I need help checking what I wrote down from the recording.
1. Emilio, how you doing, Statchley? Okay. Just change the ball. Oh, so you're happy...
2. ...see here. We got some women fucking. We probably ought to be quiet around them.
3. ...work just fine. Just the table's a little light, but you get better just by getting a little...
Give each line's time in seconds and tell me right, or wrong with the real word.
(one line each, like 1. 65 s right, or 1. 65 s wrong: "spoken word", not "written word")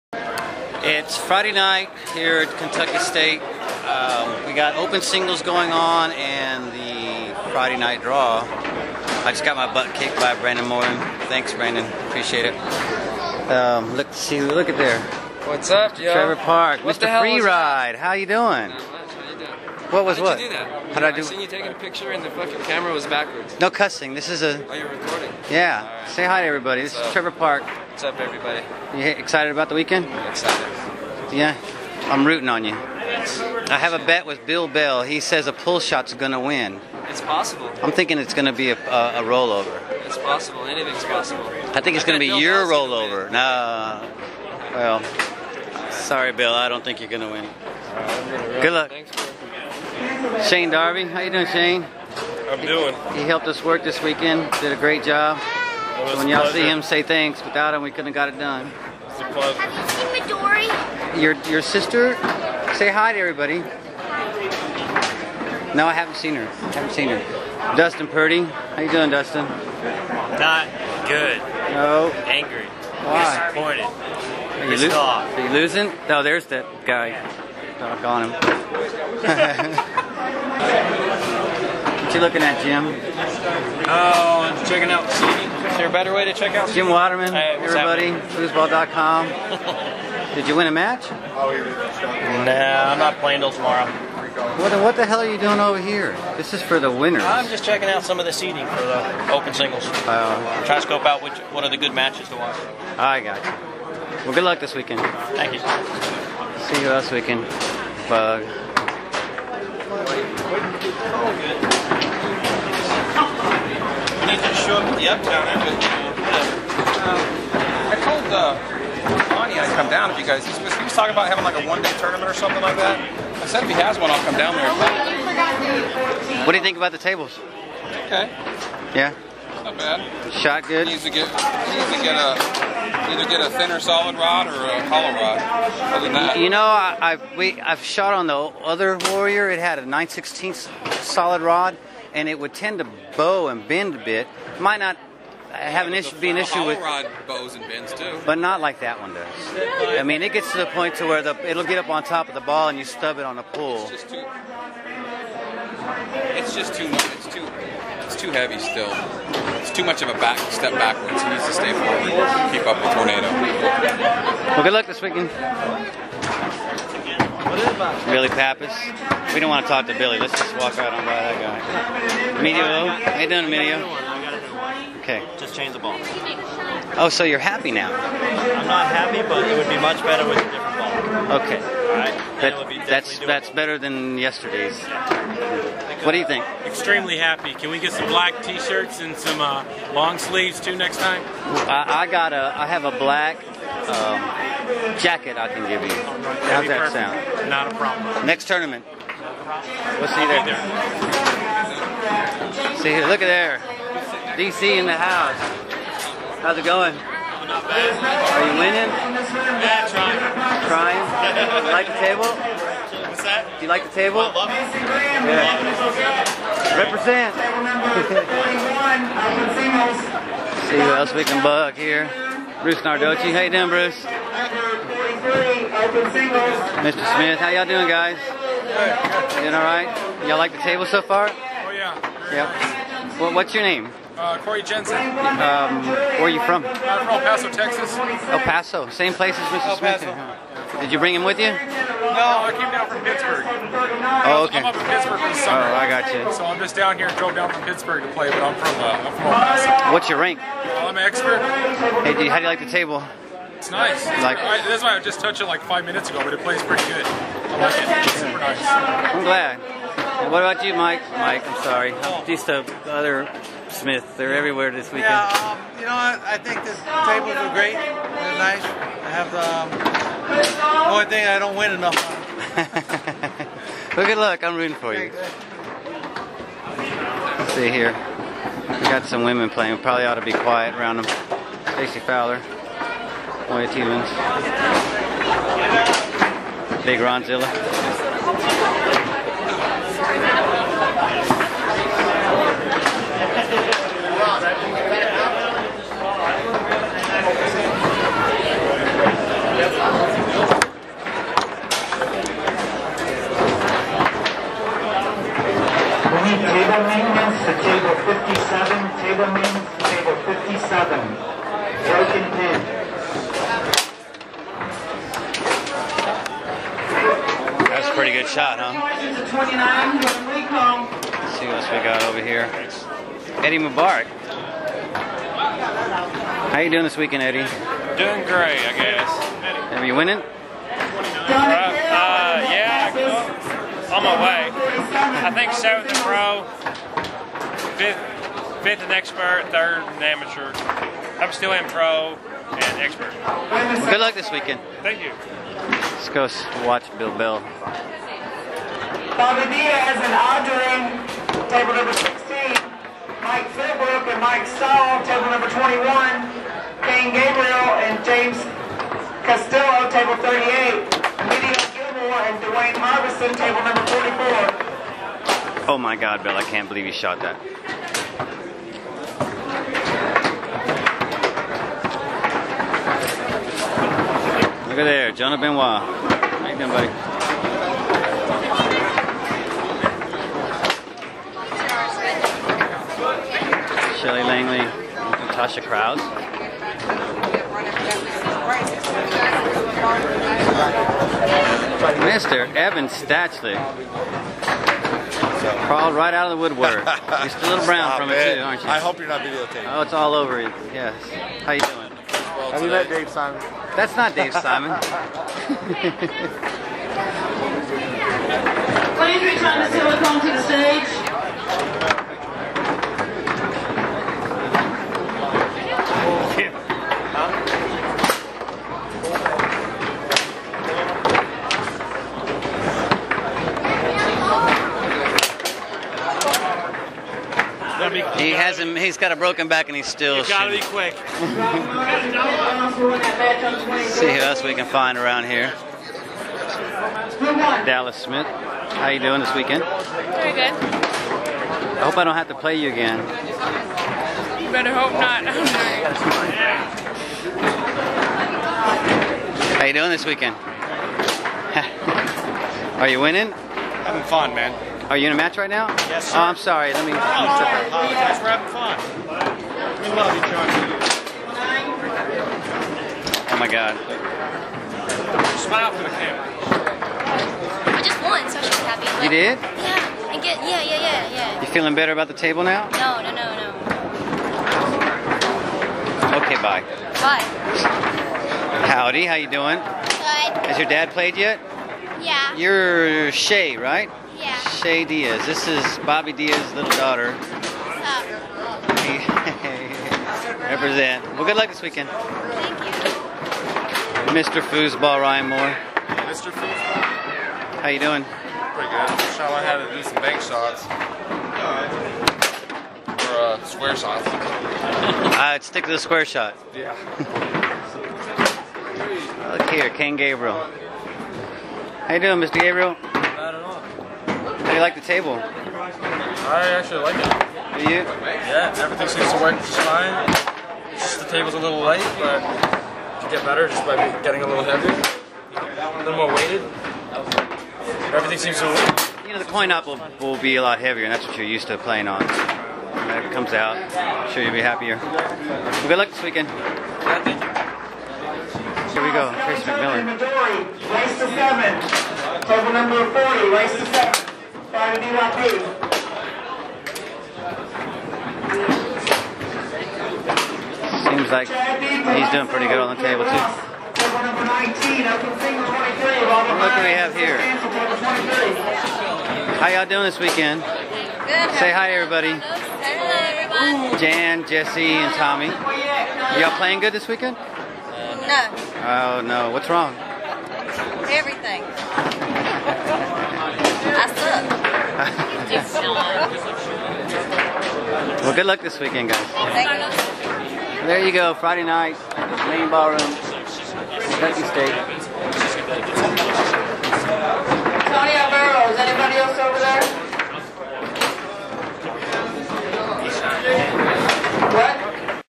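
1. 172 s wrong: "Emilio", not "Statchley"
2. 277 s wrong: "playing", not "fucking"
3. 519 s right.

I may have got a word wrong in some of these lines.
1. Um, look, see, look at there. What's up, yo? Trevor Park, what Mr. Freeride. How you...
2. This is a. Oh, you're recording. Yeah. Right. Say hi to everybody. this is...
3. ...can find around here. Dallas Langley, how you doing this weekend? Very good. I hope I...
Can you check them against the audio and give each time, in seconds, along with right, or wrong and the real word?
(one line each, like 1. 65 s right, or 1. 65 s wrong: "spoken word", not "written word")
1. 13 s right
2. 24 s right
3. 434 s wrong: "Smith", not "Langley".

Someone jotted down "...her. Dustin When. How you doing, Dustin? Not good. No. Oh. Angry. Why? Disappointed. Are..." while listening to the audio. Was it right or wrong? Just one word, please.
wrong.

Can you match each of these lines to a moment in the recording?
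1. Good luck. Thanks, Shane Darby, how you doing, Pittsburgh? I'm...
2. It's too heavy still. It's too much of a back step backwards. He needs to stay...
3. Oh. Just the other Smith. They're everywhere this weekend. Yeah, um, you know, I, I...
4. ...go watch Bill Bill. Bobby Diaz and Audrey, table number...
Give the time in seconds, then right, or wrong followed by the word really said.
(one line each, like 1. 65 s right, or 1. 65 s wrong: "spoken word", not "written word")
1. 48 s wrong: "Shane", not "Pittsburgh"
2. 158 s right
3. 261 s right
4. 346 s right.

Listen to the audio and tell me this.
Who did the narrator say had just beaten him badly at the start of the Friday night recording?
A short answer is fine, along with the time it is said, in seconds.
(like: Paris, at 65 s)
Brandon Morton, at 10 s.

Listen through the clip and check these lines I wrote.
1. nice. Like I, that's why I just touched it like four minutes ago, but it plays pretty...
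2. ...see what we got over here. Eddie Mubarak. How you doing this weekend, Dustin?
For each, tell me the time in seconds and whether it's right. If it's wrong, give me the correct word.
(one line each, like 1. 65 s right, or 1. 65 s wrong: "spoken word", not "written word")
1. 253 s wrong: "five", not "four"
2. 321 s wrong: "Eddie", not "Dustin".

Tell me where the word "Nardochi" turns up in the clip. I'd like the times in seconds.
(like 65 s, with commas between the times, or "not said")
222 s.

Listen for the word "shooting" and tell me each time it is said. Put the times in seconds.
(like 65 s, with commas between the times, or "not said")
430 s.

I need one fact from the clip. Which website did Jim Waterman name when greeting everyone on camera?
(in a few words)
foosball.com.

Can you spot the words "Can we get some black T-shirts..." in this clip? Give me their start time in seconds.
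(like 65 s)
187 s.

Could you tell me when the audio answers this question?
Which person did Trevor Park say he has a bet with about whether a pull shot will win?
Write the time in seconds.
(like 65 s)
34 s.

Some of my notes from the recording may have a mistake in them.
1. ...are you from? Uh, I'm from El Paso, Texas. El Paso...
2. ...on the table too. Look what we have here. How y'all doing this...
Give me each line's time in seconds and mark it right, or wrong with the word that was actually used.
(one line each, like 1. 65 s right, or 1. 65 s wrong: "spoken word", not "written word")
1. 236 s right
2. 552 s right.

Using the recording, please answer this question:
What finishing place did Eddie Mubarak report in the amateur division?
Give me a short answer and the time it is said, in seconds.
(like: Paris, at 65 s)
third, at 339 s.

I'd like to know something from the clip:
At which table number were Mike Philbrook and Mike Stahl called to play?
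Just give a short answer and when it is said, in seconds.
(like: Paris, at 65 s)
21, at 355 s.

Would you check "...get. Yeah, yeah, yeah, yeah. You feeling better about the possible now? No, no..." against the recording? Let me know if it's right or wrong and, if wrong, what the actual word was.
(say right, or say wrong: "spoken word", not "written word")
wrong: "table", not "possible".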